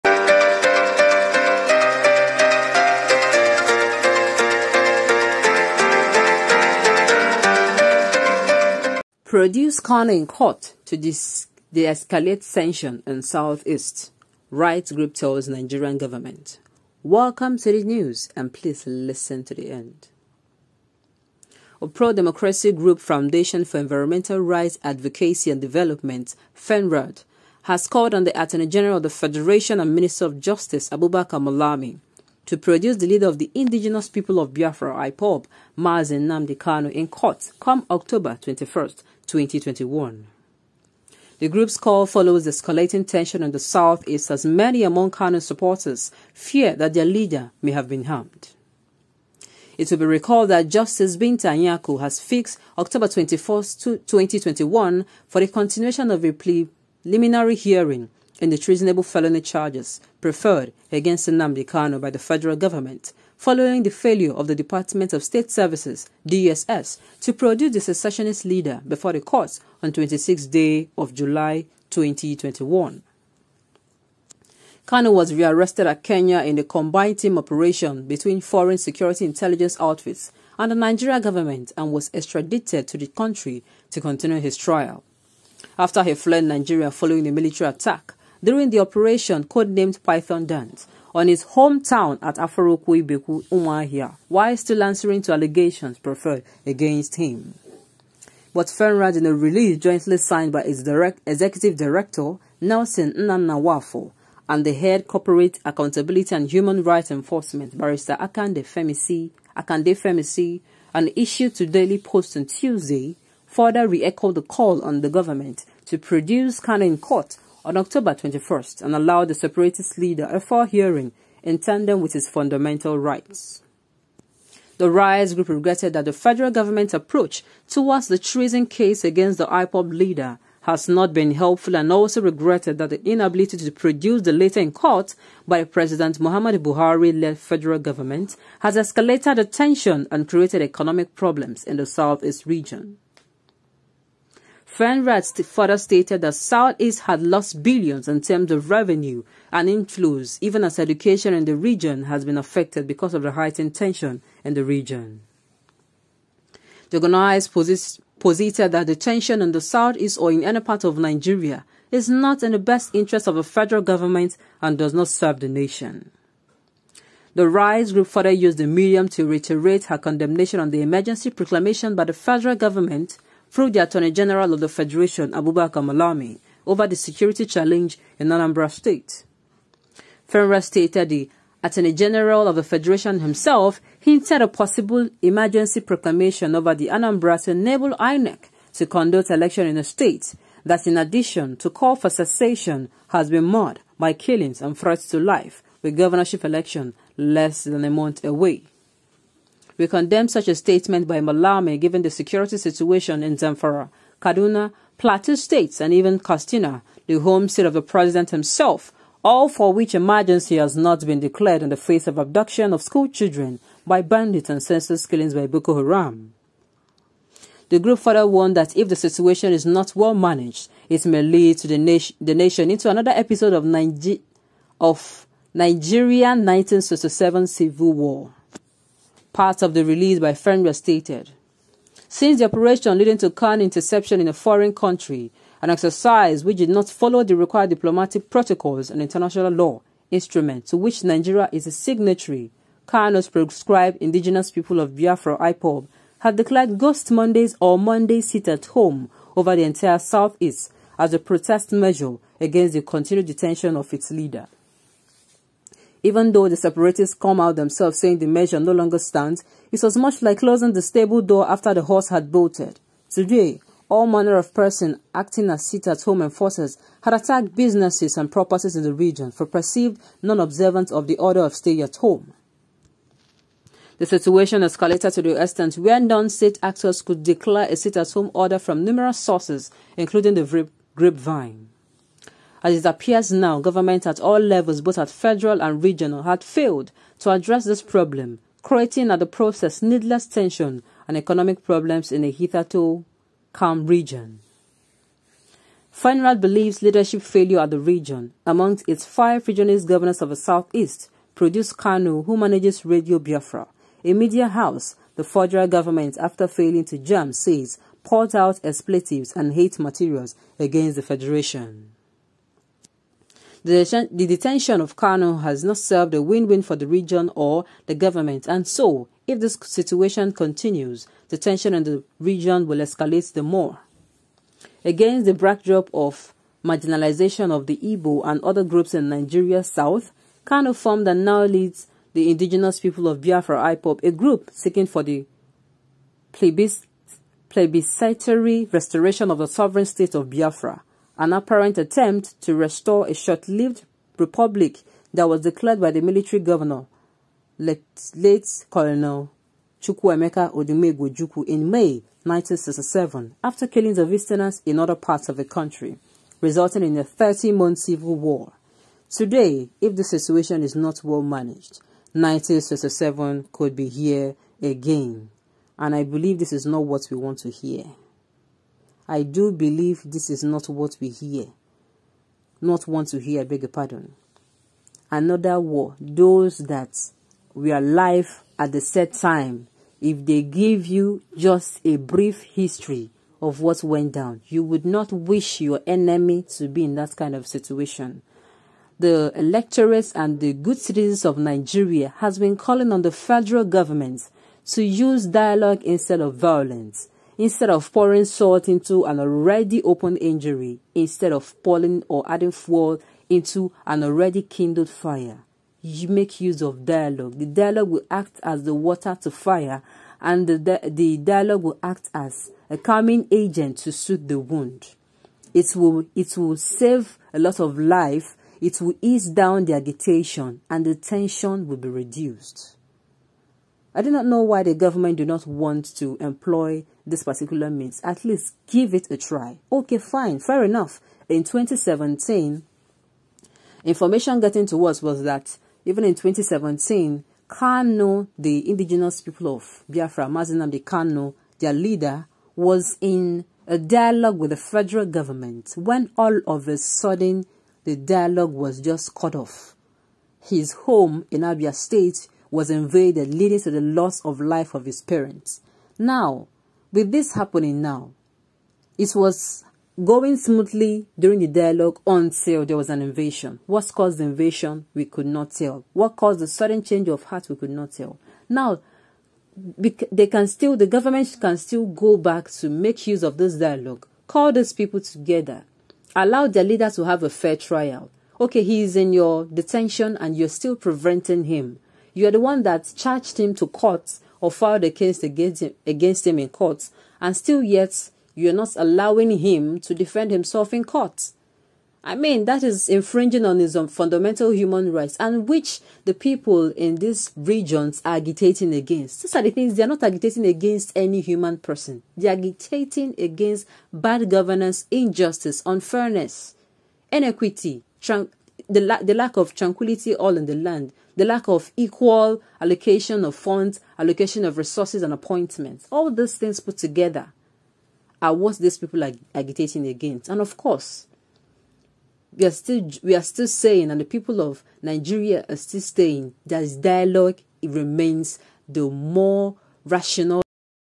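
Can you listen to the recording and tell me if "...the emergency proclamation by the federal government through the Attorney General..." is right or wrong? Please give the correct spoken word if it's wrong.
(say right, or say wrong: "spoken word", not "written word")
right.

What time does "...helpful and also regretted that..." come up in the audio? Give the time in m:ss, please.
2:11.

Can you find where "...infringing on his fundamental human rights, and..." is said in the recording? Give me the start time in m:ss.
8:12.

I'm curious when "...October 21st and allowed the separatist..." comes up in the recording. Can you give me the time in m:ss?
1:57.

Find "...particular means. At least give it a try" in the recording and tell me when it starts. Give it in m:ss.
7:07.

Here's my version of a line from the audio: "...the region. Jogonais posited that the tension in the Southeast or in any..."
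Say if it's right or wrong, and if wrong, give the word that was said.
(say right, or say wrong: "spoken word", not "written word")
right.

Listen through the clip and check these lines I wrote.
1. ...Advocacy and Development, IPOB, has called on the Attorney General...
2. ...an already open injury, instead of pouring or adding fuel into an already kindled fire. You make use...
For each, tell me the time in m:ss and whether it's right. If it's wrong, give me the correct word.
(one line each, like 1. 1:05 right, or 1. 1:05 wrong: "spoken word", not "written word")
1. 0:24 wrong: "FENRAD", not "IPOB"
2. 6:39 right.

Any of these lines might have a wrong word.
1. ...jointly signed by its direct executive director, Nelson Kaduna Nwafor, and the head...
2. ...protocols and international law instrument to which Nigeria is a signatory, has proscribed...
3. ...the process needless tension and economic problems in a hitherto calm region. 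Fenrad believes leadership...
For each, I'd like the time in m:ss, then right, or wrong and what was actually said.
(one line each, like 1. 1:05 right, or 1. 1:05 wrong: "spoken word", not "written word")
1. 1:39 wrong: "Nnanna", not "Kaduna"
2. 3:58 right
3. 4:49 right.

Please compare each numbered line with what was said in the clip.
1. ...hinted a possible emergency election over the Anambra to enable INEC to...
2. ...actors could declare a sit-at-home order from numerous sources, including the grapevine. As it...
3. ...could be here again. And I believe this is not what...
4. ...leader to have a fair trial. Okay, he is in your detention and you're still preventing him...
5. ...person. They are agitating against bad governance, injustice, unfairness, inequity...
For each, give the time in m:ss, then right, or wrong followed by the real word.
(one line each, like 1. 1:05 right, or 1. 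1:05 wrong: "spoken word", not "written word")
1. 3:03 wrong: "proclamation", not "election"
2. 4:36 right
3. 6:03 right
4. 7:56 right
5. 8:21 right.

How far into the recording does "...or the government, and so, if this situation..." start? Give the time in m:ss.
5:17.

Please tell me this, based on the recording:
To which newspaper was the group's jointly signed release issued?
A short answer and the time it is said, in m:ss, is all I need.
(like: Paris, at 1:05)
Daily Post, at 1:51.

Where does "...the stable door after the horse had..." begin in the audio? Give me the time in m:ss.
4:20.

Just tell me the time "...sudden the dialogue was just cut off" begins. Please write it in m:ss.
7:26.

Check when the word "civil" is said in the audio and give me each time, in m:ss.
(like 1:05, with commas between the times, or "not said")
3:47, 5:57.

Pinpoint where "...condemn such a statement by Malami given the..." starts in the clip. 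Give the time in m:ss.
3:19.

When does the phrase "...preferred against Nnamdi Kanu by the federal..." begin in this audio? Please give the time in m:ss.
1:00.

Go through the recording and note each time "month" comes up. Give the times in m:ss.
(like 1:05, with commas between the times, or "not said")
3:17, 5:57.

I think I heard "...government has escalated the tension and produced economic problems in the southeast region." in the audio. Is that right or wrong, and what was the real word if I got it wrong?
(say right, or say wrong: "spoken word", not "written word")
wrong: "created", not "produced".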